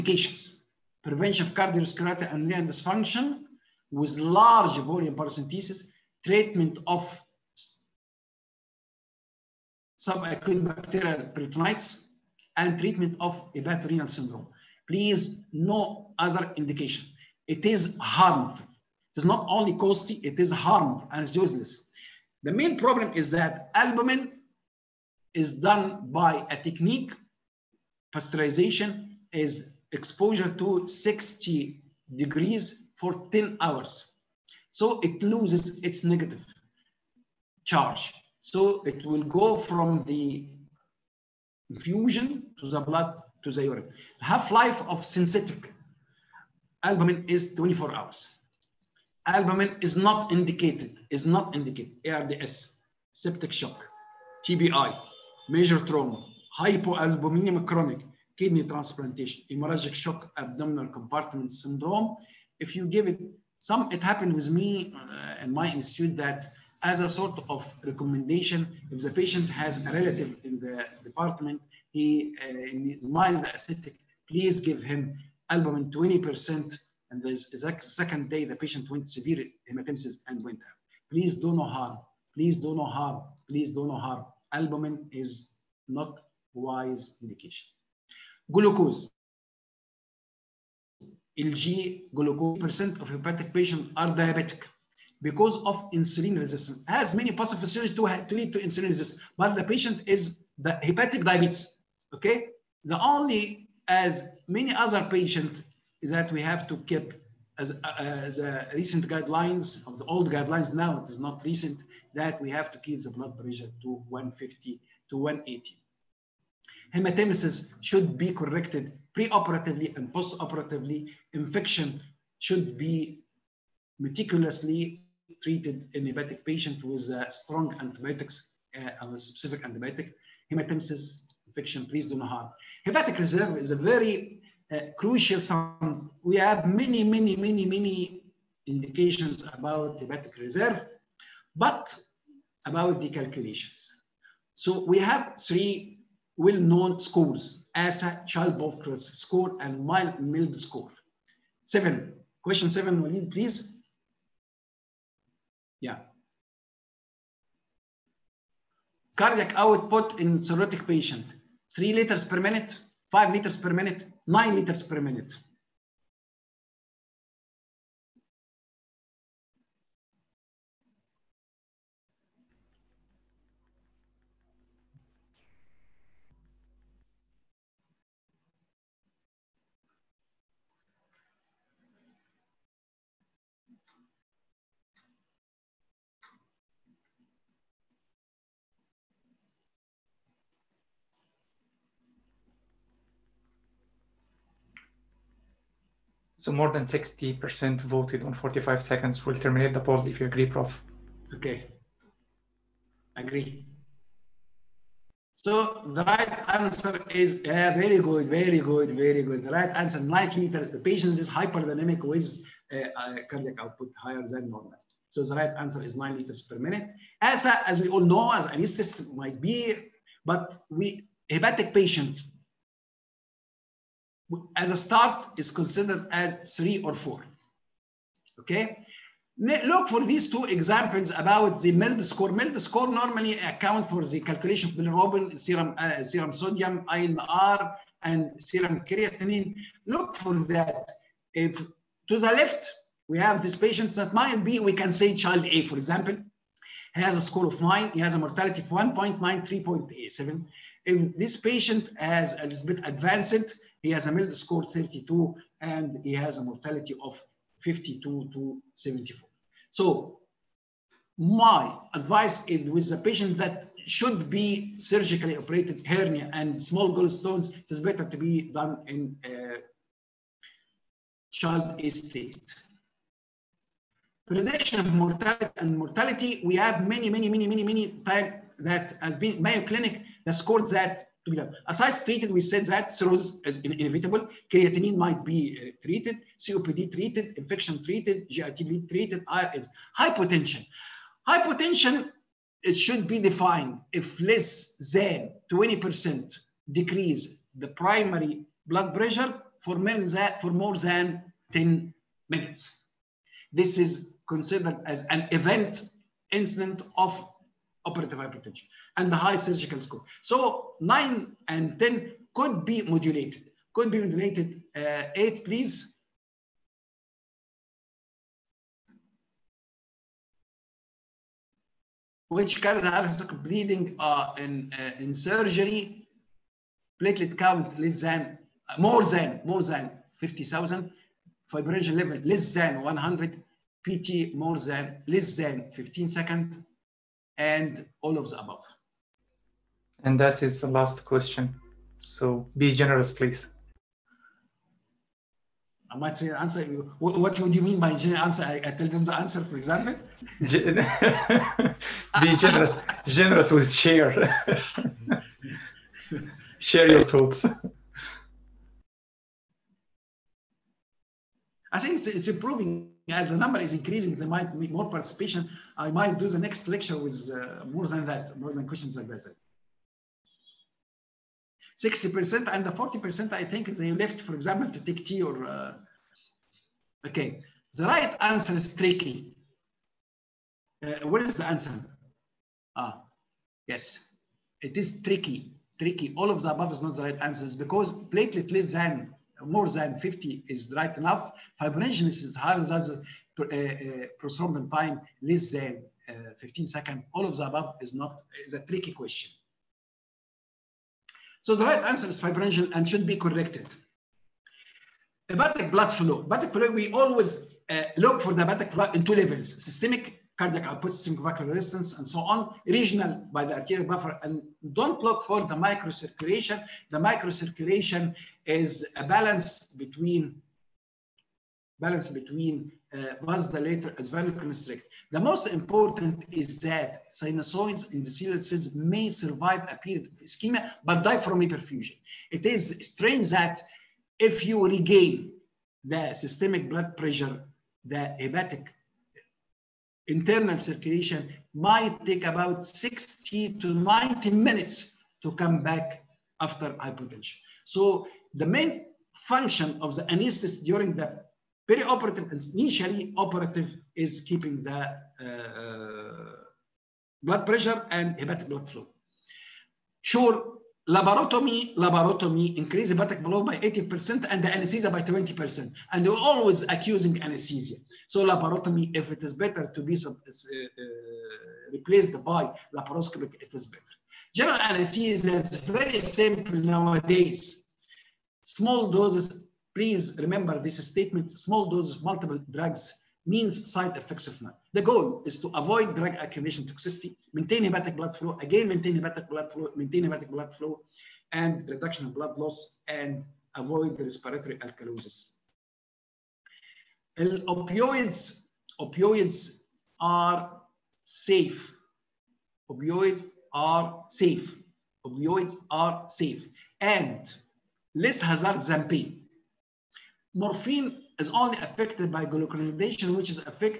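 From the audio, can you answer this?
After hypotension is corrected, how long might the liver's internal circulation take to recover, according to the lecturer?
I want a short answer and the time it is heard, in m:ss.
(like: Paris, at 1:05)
60 to 90 minutes, at 7:22.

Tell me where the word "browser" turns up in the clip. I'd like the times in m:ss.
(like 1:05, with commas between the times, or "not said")
not said.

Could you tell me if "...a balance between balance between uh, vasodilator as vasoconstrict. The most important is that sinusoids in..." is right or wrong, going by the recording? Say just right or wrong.
right.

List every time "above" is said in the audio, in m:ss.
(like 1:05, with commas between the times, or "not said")
5:38, 6:26, 6:37.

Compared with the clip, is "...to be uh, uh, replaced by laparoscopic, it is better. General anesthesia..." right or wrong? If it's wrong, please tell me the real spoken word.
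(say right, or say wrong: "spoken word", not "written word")
right.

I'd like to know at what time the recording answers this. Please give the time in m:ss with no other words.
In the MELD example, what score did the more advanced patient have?
4:14.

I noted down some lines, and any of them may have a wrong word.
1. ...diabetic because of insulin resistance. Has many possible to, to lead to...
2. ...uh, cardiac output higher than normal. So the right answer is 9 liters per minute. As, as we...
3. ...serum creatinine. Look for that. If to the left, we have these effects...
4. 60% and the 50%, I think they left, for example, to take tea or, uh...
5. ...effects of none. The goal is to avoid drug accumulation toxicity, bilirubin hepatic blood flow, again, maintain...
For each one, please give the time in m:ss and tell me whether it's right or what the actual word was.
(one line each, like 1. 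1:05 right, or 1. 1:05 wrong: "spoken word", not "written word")
1. 1:34 right
2. 3:32 right
3. 3:58 wrong: "patients", not "effects"
4. 6:11 wrong: "40", not "50"
5. 8:03 wrong: "maintain", not "bilirubin".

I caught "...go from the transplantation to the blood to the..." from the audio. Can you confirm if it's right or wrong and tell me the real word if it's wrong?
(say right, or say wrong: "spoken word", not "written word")
wrong: "infusion", not "transplantation".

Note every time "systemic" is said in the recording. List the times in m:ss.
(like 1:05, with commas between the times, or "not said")
6:49, 7:16.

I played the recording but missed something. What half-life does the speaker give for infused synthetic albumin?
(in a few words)
24 hours.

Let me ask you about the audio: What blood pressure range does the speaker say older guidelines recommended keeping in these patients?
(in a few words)
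150 to 180.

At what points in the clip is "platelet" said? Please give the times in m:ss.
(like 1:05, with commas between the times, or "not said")
5:27, 6:27.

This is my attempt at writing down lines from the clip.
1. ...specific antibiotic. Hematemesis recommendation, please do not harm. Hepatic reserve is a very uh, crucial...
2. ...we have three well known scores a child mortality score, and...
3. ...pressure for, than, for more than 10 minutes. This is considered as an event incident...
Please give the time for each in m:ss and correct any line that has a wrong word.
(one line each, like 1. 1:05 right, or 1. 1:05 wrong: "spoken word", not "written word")
1. 2:09 wrong: "infection", not "recommendation"
2. 2:24 wrong: "poverty", not "mortality"
3. 4:58 right.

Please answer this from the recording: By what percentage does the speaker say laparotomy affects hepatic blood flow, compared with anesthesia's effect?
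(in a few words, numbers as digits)
80%.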